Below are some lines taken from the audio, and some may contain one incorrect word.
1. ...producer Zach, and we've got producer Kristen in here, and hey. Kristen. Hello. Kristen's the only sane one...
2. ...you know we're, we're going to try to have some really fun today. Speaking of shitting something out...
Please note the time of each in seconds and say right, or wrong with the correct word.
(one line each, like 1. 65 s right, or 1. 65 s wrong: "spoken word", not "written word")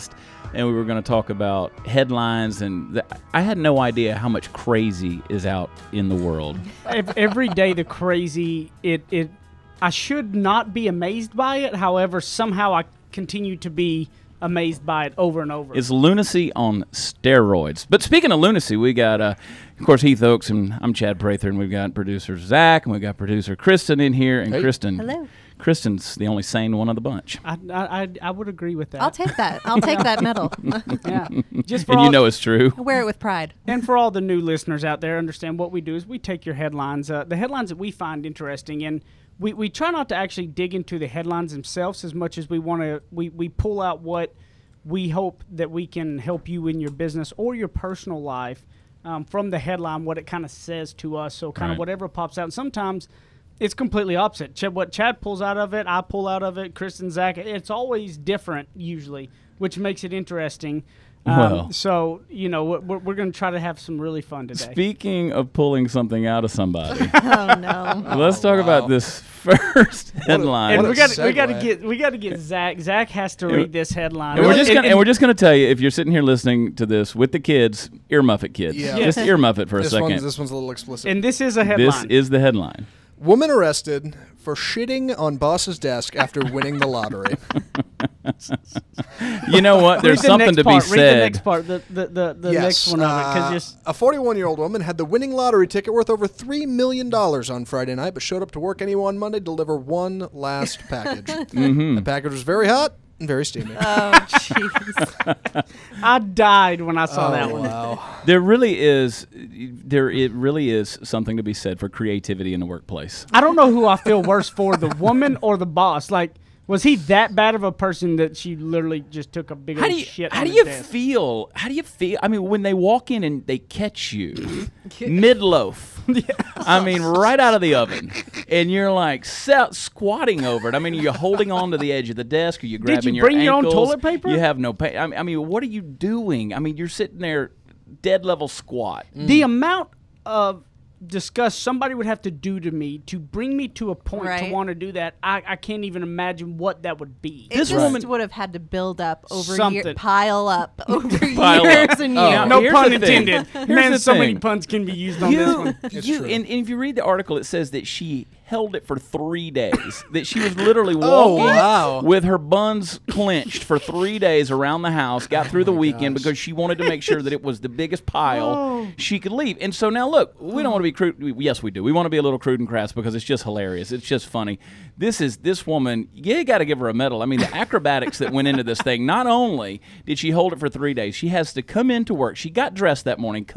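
1. 21 s right
2. 62 s wrong: "pulling", not "shitting".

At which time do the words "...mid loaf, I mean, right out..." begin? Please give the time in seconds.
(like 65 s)
125 s.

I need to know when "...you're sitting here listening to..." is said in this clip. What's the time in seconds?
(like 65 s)
75 s.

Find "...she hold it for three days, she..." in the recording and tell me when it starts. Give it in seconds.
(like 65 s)
180 s.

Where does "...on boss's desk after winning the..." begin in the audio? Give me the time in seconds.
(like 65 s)
85 s.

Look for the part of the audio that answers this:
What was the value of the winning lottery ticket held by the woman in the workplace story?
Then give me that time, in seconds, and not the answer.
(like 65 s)
96 s.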